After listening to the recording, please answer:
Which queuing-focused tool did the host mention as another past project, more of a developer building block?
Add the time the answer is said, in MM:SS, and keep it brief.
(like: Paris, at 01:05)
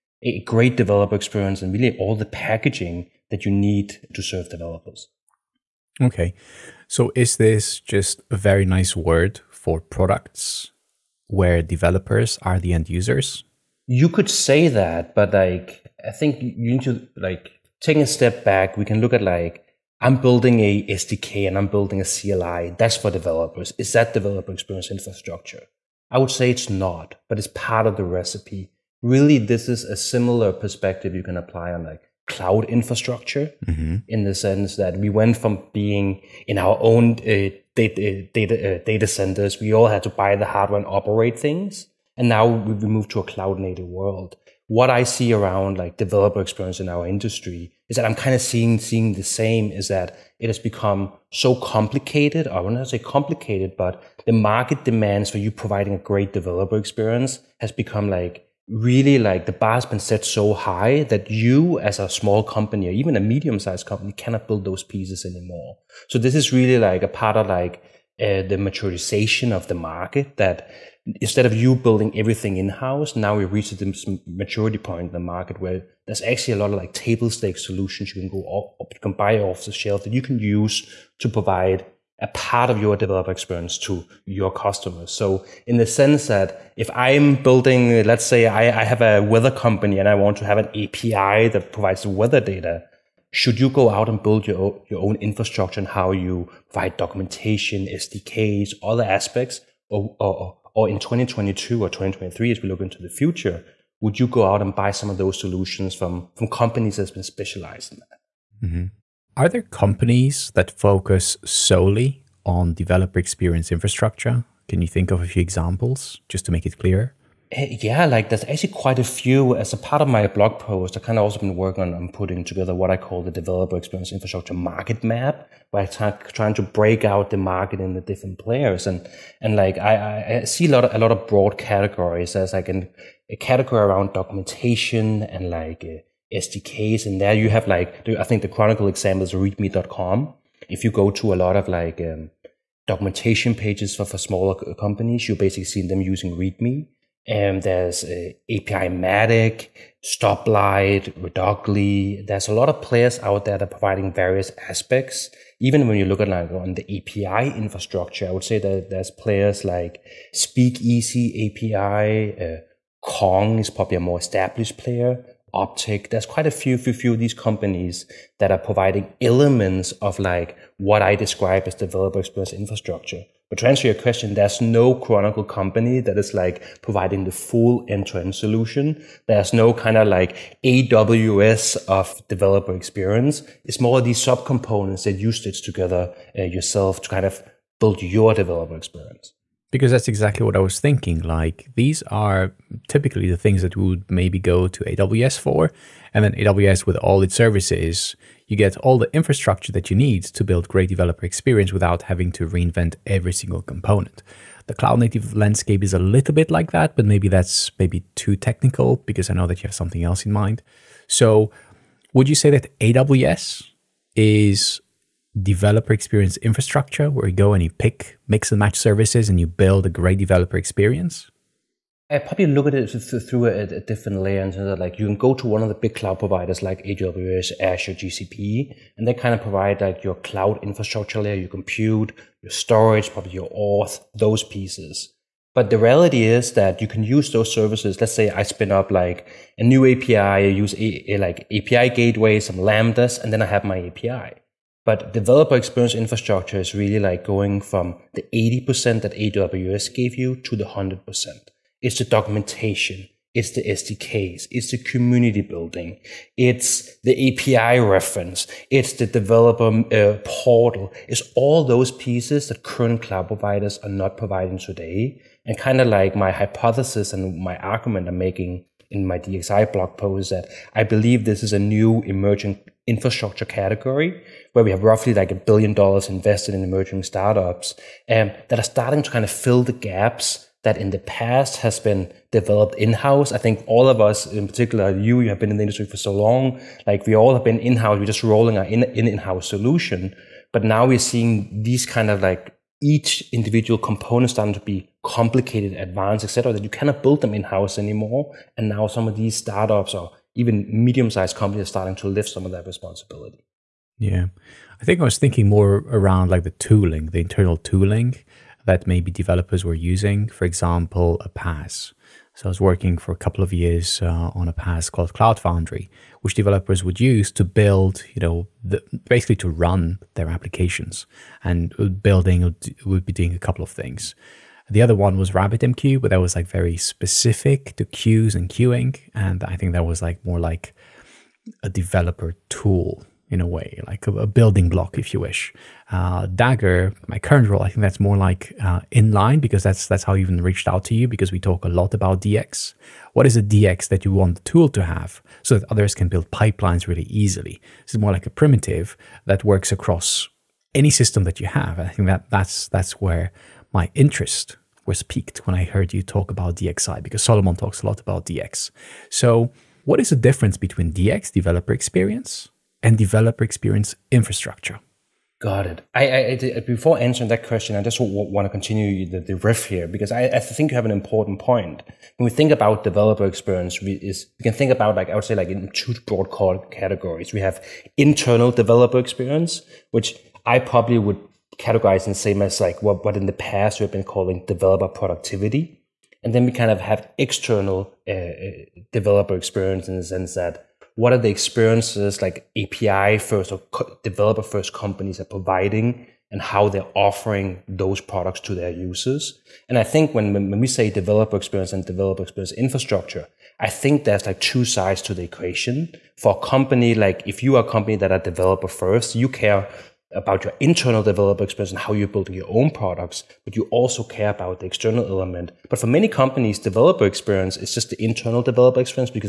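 RabbitMQ, at 05:25.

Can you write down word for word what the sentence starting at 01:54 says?
Can you think of a few examples just to make it clear?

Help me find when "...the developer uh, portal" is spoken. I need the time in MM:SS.
04:18.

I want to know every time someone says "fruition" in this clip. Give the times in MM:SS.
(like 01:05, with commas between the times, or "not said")
not said.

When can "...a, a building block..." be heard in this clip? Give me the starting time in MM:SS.
05:34.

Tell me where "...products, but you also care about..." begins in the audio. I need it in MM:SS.
06:52.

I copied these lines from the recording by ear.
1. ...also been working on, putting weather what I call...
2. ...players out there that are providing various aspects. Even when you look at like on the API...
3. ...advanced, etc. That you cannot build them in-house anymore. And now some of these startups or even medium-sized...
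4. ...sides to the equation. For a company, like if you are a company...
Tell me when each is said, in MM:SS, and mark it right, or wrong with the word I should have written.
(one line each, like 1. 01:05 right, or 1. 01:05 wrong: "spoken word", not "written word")
1. 02:01 wrong: "together", not "weather"
2. 02:32 right
3. 04:55 right
4. 06:44 right.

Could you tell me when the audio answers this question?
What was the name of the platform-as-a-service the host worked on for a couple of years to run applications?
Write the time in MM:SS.
05:15.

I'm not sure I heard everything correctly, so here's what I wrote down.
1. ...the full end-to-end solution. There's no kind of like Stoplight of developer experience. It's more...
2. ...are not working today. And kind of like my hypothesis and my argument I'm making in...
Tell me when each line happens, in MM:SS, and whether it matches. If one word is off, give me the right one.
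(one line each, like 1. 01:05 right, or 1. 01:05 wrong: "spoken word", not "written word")
1. 02:57 wrong: "AWS", not "Stoplight"
2. 04:23 wrong: "providing", not "working".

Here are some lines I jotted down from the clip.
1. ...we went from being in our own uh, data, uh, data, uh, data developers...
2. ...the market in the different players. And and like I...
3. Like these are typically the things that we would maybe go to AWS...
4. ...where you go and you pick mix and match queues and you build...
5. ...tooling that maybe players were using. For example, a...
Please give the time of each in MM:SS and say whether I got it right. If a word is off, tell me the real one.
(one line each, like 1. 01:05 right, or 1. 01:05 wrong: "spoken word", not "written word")
1. 00:34 wrong: "centers", not "developers"
2. 02:07 right
3. 03:11 right
4. 03:37 wrong: "services", not "queues"
5. 05:07 wrong: "developers", not "players".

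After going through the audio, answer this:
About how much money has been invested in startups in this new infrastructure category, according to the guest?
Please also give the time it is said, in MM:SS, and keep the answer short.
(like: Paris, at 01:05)
$1 billion, at 04:35.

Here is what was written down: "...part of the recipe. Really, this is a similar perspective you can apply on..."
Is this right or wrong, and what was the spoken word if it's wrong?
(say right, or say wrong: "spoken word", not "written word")
right.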